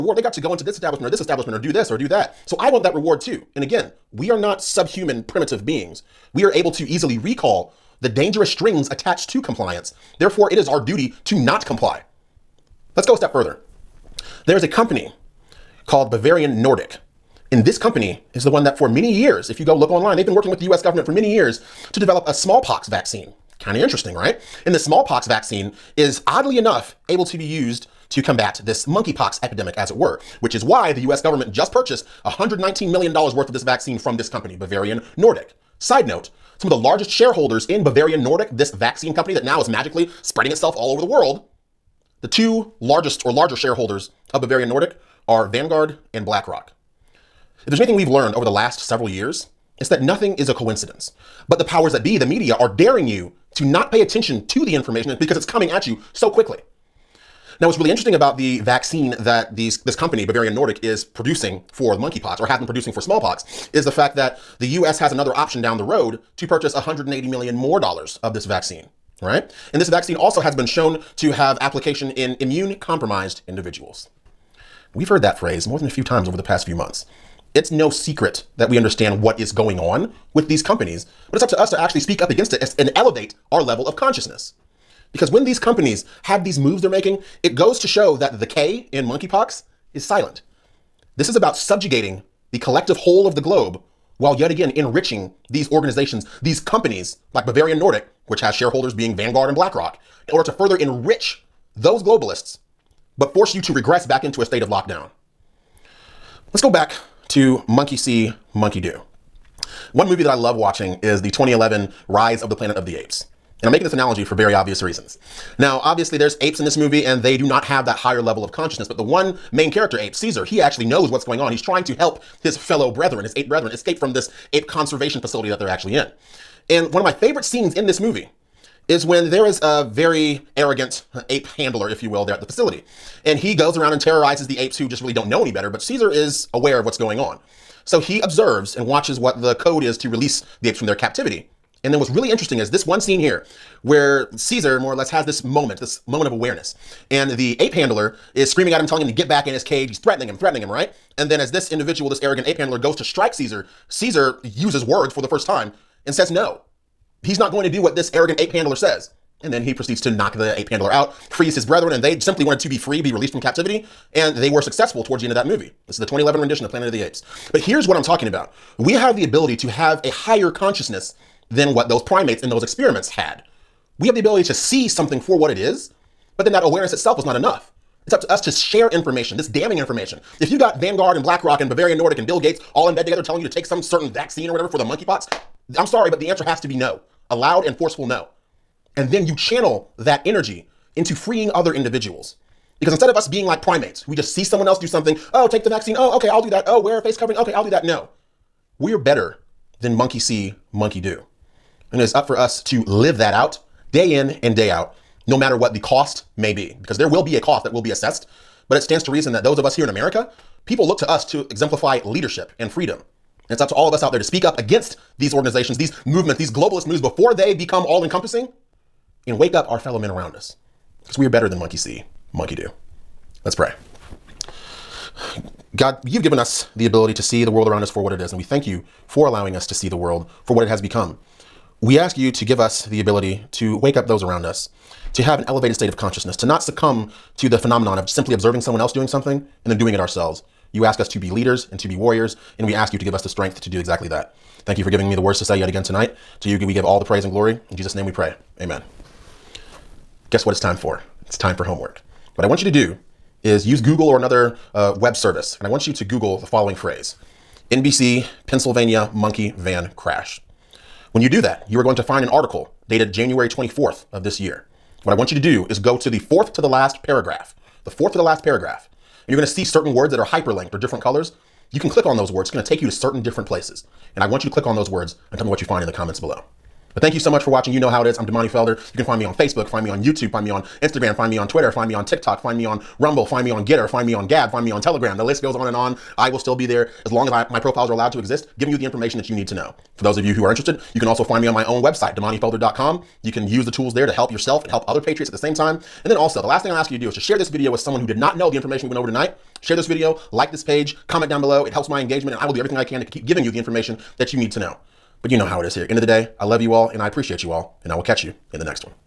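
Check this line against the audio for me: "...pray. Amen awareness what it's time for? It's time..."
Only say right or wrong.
wrong.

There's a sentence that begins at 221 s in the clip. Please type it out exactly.
Because we are better than monkey see, monkey do.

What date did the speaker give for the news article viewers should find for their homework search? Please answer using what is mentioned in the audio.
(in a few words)
January 24th.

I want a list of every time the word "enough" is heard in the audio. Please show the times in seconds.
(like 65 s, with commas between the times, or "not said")
26 s, 177 s.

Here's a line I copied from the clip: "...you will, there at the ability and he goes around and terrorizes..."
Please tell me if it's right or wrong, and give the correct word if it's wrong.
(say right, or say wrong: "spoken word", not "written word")
wrong: "facility", not "ability".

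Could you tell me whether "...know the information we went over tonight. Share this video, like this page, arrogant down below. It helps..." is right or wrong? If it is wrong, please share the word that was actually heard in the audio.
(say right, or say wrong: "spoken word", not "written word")
wrong: "comment", not "arrogant".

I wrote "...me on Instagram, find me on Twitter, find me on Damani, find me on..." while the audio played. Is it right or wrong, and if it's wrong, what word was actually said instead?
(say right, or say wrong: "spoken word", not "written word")
wrong: "TikTok", not "Damani".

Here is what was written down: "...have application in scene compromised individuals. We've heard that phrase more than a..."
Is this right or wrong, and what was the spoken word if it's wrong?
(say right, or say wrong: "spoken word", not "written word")
wrong: "immune", not "scene".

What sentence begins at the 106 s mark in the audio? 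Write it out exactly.
Let's go back to Monkey See, Monkey Do.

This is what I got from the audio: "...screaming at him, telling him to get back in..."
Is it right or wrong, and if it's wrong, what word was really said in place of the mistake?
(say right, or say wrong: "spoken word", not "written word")
right.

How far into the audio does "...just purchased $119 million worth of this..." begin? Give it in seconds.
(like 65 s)
31 s.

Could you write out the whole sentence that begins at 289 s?
For those of you who are interested, you can also find me on my own website, damanifelder.com.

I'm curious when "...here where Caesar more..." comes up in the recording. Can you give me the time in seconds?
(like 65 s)
143 s.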